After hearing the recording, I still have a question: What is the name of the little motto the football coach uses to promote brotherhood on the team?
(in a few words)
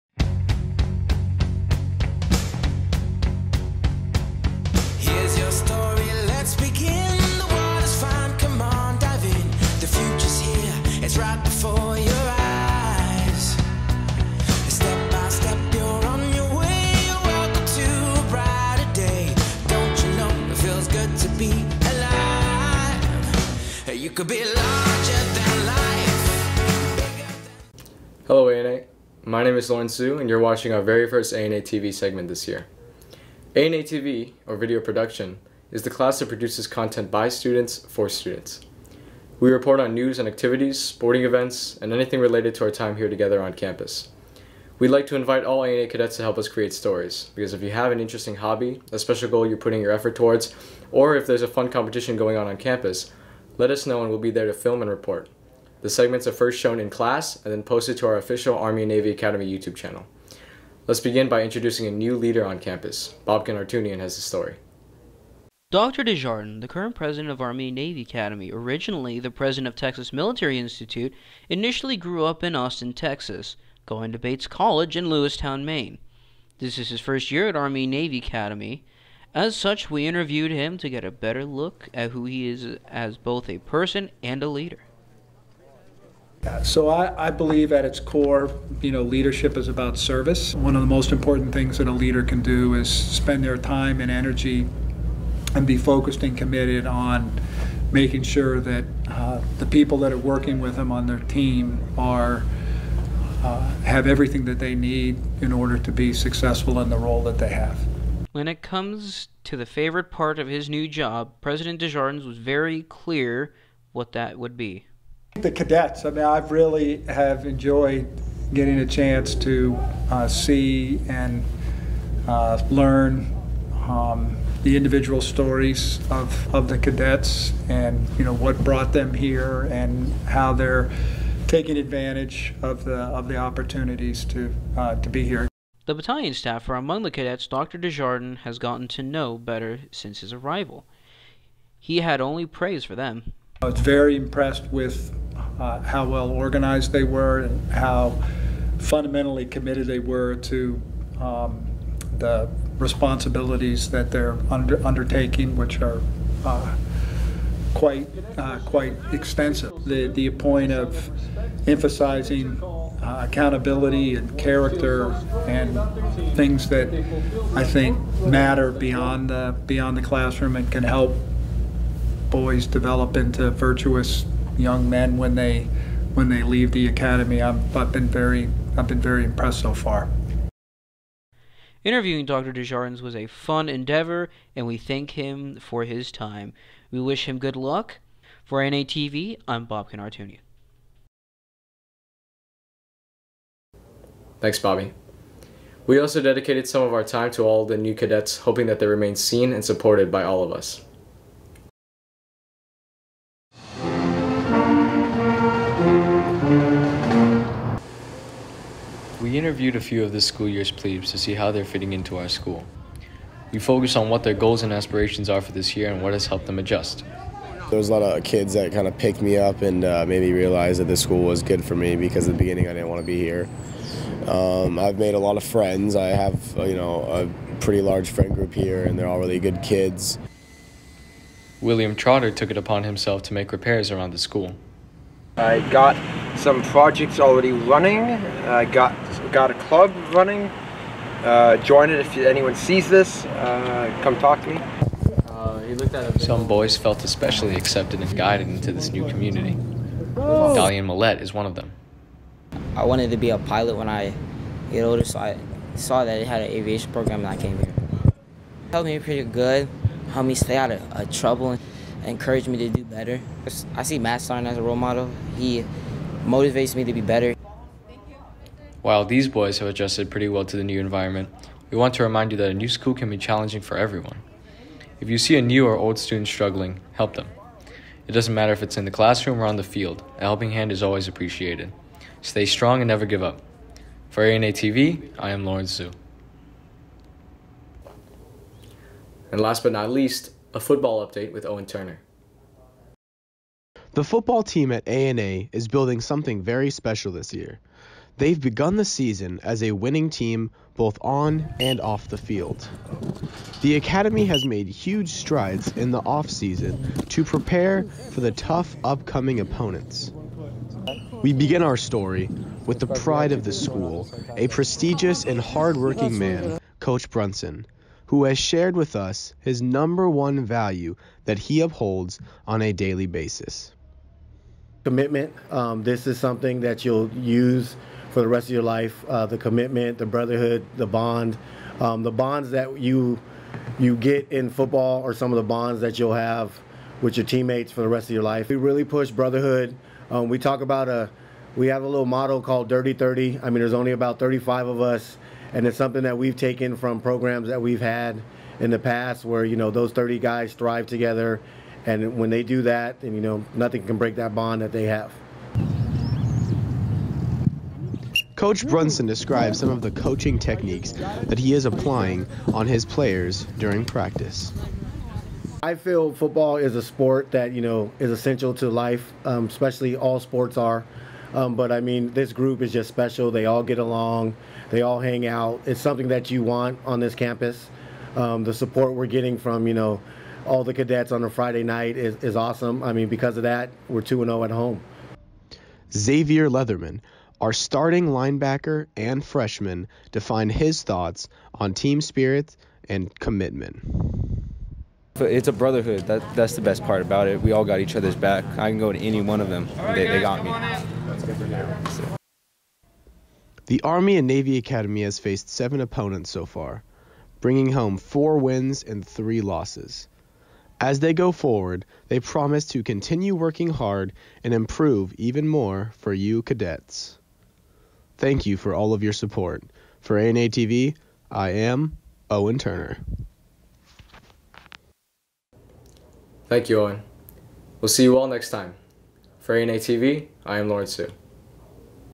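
Dirty 30.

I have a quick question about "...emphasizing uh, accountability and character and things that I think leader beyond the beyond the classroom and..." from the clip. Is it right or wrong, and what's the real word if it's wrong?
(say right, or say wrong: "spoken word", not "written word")
wrong: "matter", not "leader".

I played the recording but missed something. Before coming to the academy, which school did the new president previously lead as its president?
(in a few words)
Texas Military Institute.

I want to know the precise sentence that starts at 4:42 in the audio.
Stay strong and never give up.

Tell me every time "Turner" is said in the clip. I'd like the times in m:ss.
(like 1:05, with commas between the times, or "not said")
4:51, 7:02.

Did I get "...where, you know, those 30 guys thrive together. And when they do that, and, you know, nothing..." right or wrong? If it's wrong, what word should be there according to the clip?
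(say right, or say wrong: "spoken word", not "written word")
right.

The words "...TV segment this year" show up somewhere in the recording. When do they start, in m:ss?
0:31.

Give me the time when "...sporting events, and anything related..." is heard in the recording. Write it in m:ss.
0:40.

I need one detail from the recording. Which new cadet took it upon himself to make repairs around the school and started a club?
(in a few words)
William Trotter.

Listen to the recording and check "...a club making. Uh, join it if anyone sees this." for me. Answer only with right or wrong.
wrong.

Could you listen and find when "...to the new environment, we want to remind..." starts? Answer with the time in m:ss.
4:30.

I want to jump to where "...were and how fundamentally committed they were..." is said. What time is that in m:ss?
2:27.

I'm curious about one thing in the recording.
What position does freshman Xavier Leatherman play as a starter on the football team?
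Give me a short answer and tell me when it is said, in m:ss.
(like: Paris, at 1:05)
Linebacker, at 6:28.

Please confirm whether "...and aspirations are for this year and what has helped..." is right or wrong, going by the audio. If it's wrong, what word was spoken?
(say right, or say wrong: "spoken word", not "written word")
right.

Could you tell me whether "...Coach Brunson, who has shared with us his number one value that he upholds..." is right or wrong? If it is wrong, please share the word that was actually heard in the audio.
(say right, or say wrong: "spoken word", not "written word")
right.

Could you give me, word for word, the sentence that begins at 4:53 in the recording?
The football team at ANA is building something very special this year.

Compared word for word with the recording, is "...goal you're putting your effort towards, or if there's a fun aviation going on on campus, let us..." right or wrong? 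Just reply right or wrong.
wrong.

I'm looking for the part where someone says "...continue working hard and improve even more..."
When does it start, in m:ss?
6:52.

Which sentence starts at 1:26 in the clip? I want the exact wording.
So I, I, believe at its core, you know, leadership is about service.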